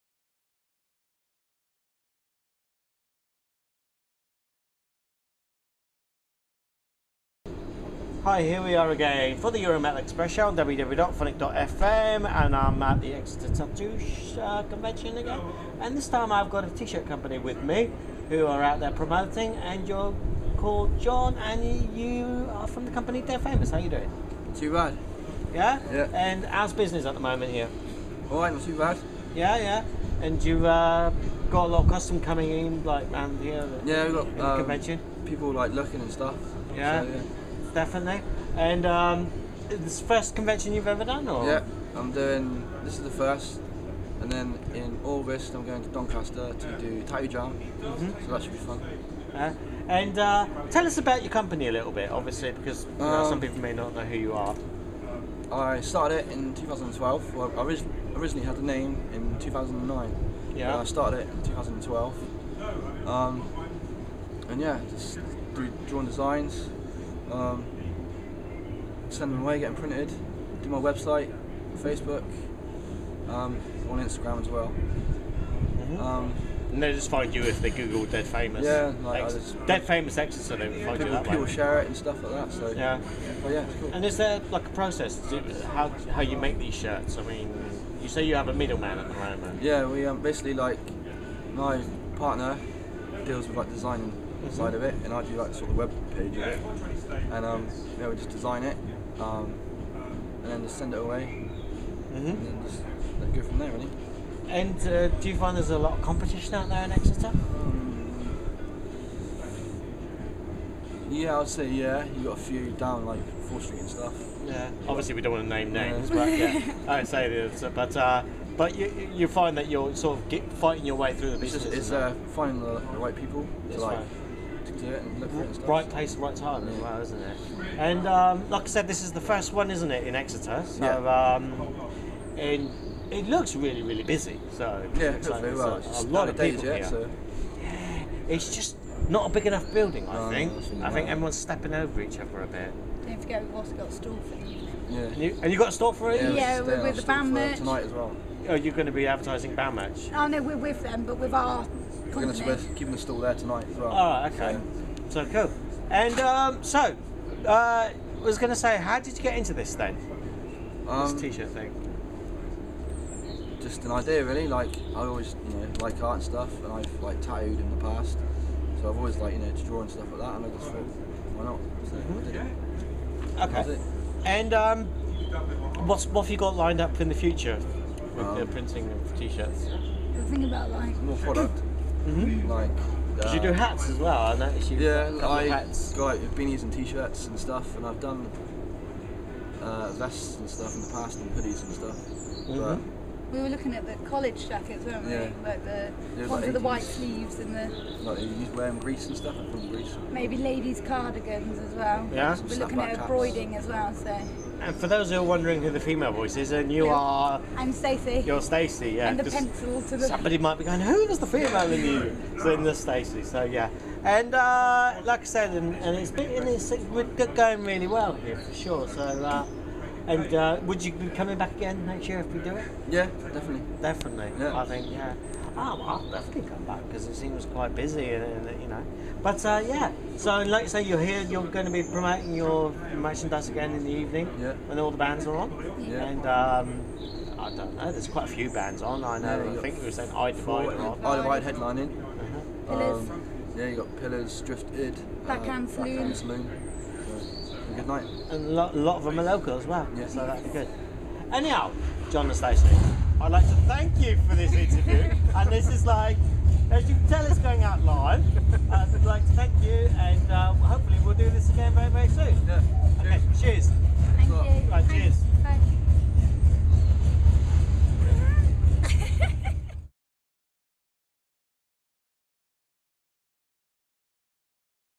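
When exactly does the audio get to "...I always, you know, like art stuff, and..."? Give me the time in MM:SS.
02:44.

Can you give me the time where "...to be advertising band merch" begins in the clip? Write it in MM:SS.
02:28.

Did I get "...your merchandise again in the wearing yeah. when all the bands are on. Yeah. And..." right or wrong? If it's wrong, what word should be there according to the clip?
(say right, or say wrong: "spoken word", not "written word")
wrong: "evening", not "wearing".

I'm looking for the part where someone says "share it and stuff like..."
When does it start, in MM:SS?
01:21.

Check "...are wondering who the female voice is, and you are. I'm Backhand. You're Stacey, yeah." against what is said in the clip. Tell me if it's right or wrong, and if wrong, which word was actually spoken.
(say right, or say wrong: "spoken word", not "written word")
wrong: "Stacey", not "Backhand".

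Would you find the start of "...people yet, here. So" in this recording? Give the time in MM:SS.
02:16.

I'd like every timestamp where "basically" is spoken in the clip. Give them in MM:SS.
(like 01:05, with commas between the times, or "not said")
01:30.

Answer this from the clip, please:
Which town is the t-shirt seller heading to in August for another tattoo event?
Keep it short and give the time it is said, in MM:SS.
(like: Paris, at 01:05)
Doncaster, at 00:45.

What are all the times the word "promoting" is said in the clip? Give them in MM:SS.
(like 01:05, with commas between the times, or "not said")
00:18, 03:51.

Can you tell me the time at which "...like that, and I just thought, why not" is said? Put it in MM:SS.
02:50.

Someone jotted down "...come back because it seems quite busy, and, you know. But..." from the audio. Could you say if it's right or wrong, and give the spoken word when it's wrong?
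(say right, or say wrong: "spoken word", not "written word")
right.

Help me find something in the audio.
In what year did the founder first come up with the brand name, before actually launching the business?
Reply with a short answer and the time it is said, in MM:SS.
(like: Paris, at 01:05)
2009, at 00:59.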